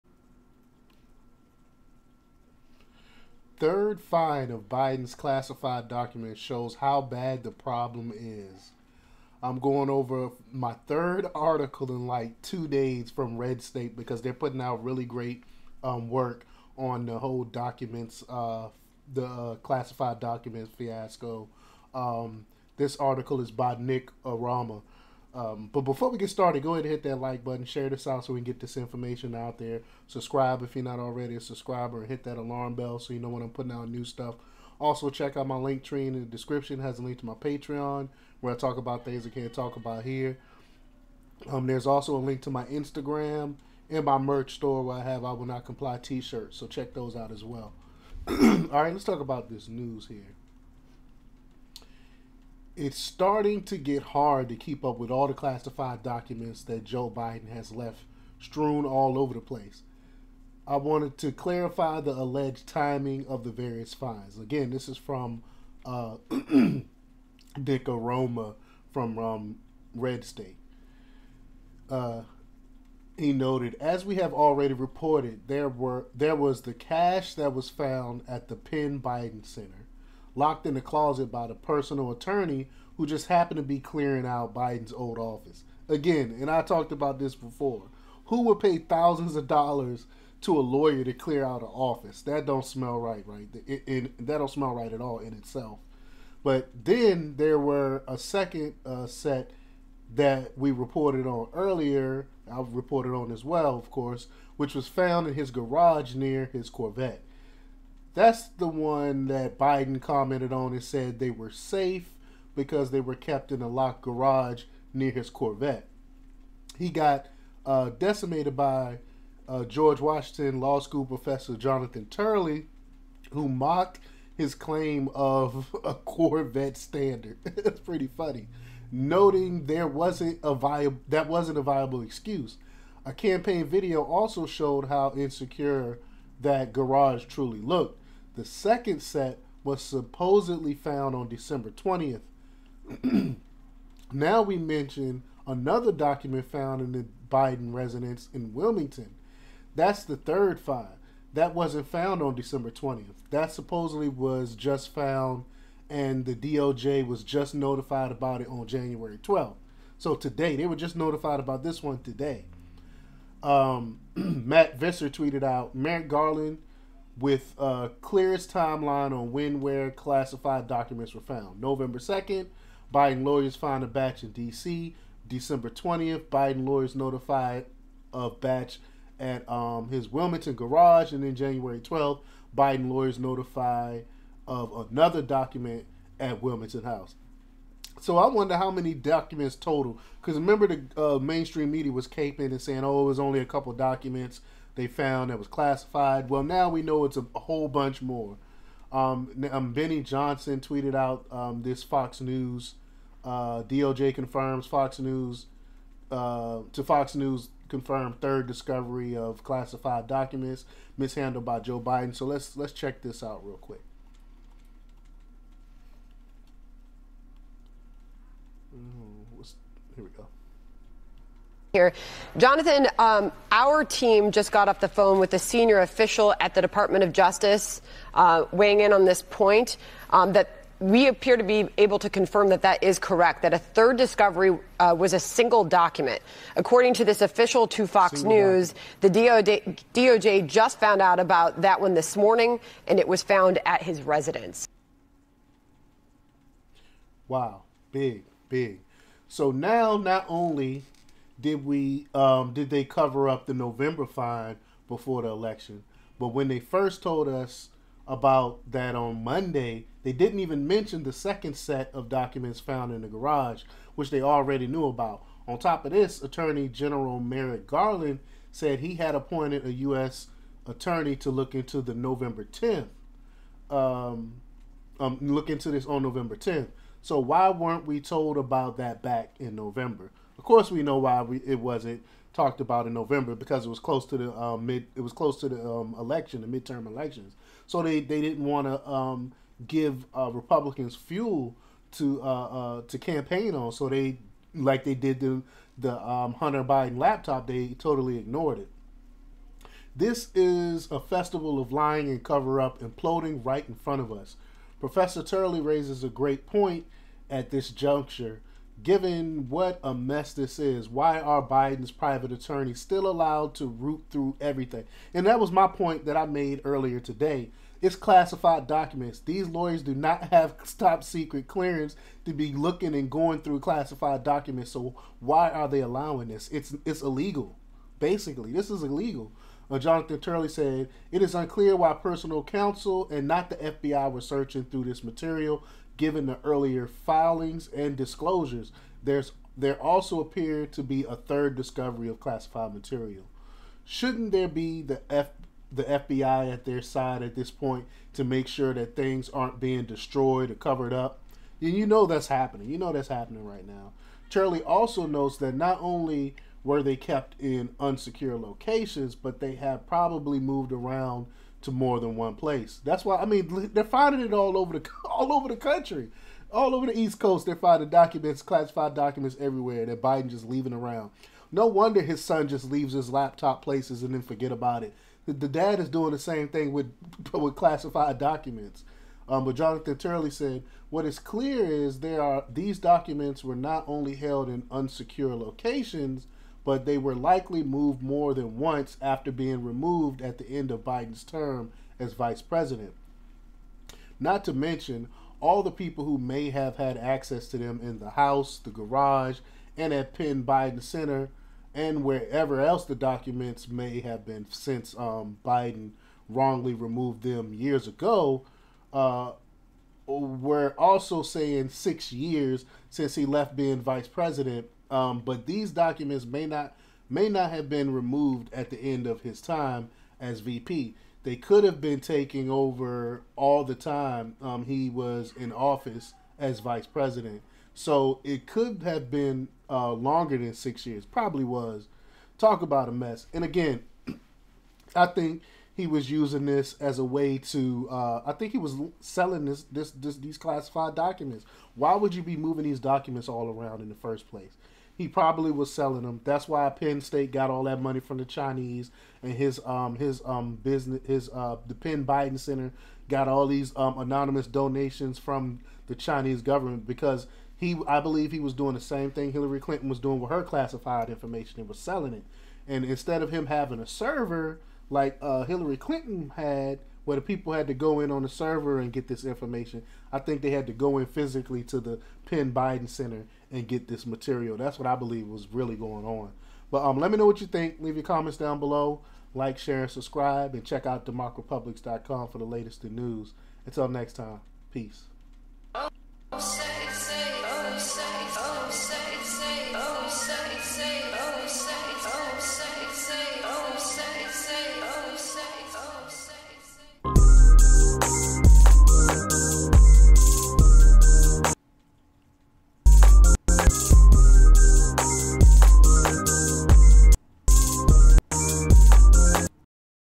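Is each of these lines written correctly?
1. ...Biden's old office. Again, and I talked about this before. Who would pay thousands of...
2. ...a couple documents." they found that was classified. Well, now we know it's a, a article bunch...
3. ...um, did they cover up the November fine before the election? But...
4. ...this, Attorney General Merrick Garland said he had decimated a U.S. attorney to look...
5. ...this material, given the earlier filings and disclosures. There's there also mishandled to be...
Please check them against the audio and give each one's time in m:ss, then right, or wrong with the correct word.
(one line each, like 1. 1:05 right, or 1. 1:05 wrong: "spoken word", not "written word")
1. 1:24 right
2. 3:13 wrong: "whole", not "article"
3. 4:12 right
4. 4:25 wrong: "appointed", not "decimated"
5. 5:34 wrong: "appeared", not "mishandled".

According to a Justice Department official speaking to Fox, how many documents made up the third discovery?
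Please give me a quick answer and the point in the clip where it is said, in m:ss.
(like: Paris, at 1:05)
1, at 3:55.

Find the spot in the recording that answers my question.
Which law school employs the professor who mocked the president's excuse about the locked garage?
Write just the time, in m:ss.
1:59.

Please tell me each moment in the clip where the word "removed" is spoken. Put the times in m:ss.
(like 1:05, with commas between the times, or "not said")
6:29, 6:46, 6:57.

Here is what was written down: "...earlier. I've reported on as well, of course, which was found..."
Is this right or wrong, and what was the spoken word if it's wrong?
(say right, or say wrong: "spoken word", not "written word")
right.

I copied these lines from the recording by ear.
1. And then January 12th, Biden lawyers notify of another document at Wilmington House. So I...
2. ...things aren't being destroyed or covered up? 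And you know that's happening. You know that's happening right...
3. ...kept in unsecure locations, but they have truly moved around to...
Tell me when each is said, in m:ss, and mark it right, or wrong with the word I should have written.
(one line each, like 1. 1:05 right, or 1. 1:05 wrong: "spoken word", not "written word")
1. 3:01 right
2. 5:48 right
3. 5:56 wrong: "probably", not "truly".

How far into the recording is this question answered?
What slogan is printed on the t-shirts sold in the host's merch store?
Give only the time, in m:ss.
0:45.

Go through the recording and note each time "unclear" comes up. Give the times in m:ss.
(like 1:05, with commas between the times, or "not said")
5:31.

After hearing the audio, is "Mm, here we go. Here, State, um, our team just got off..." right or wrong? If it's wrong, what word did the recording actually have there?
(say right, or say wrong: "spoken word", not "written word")
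wrong: "Jonathan", not "State".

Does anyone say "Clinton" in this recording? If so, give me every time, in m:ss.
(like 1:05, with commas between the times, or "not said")
7:39, 7:45.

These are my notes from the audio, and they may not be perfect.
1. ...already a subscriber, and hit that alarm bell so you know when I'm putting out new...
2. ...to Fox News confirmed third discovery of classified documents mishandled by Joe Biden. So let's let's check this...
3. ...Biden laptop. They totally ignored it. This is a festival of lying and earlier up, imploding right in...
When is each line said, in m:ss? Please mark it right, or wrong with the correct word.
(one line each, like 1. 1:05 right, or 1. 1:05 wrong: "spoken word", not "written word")
1. 0:30 right
2. 3:26 right
3. 4:56 wrong: "cover", not "earlier".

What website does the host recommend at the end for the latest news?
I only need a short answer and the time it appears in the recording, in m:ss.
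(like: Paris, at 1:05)
democrepublix.com, at 8:01.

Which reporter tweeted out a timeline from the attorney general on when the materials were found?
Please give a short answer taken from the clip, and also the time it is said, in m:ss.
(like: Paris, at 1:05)
Matt Visser, at 2:44.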